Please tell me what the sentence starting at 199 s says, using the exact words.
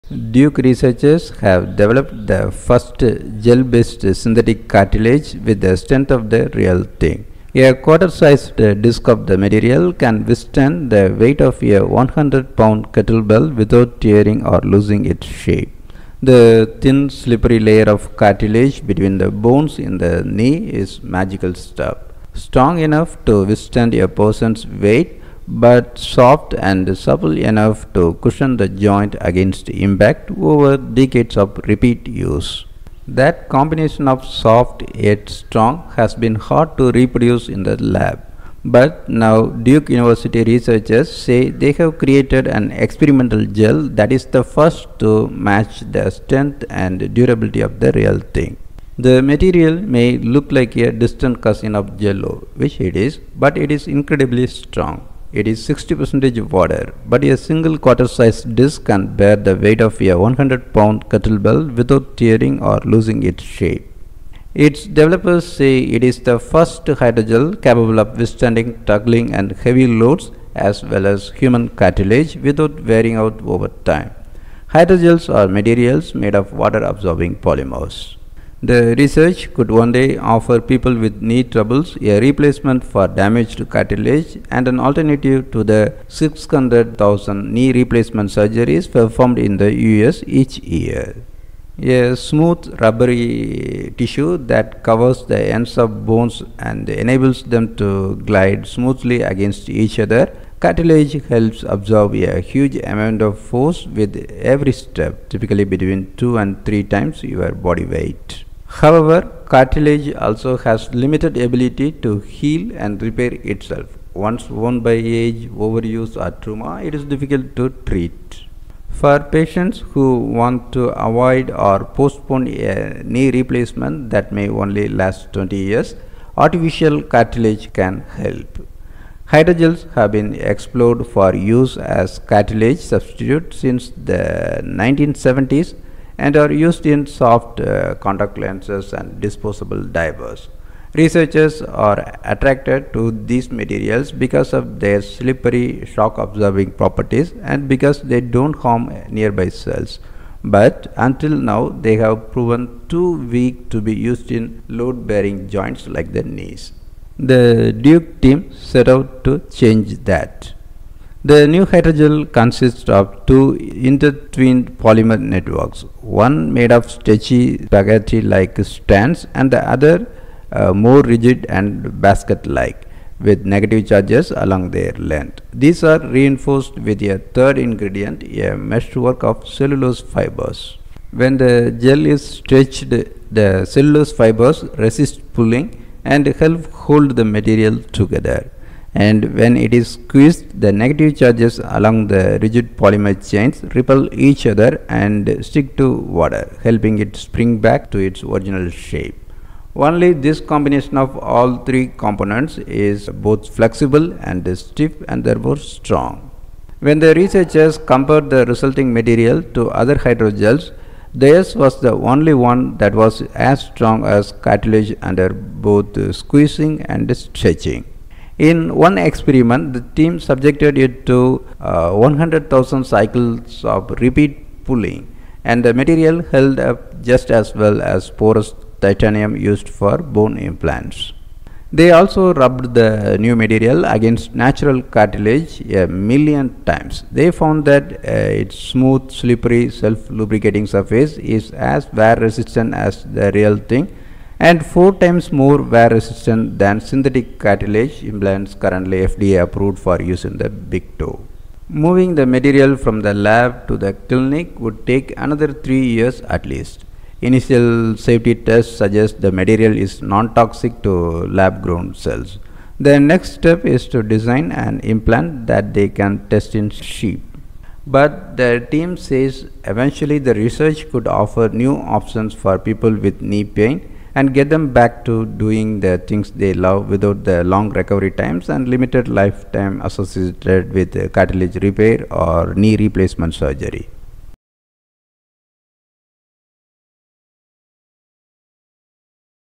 Only this combination of all three components is both flexible and stiff and therefore strong.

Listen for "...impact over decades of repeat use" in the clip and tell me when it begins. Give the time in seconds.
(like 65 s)
29 s.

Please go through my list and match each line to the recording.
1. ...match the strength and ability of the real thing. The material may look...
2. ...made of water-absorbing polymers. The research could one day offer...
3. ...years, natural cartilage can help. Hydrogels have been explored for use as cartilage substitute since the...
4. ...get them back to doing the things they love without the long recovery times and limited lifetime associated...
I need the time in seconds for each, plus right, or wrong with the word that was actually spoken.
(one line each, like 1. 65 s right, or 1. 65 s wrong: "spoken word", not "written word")
1. 45 s wrong: "durability", not "ability"
2. 76 s right
3. 125 s wrong: "artificial", not "natural"
4. 274 s right.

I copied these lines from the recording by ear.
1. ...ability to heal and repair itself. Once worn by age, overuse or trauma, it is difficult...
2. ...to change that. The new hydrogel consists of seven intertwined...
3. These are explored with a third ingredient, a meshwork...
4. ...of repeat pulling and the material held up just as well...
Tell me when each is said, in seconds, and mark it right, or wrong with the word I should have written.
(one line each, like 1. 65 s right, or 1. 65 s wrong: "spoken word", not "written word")
1. 111 s right
2. 159 s wrong: "two", not "seven"
3. 175 s wrong: "reinforced", not "explored"
4. 223 s right.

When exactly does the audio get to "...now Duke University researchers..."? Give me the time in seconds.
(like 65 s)
39 s.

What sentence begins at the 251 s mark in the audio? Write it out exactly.
Moving the material from the lab to the clinic would take another three years at least.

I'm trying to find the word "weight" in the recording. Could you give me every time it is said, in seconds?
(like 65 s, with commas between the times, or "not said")
11 s, 24 s, 59 s, 107 s.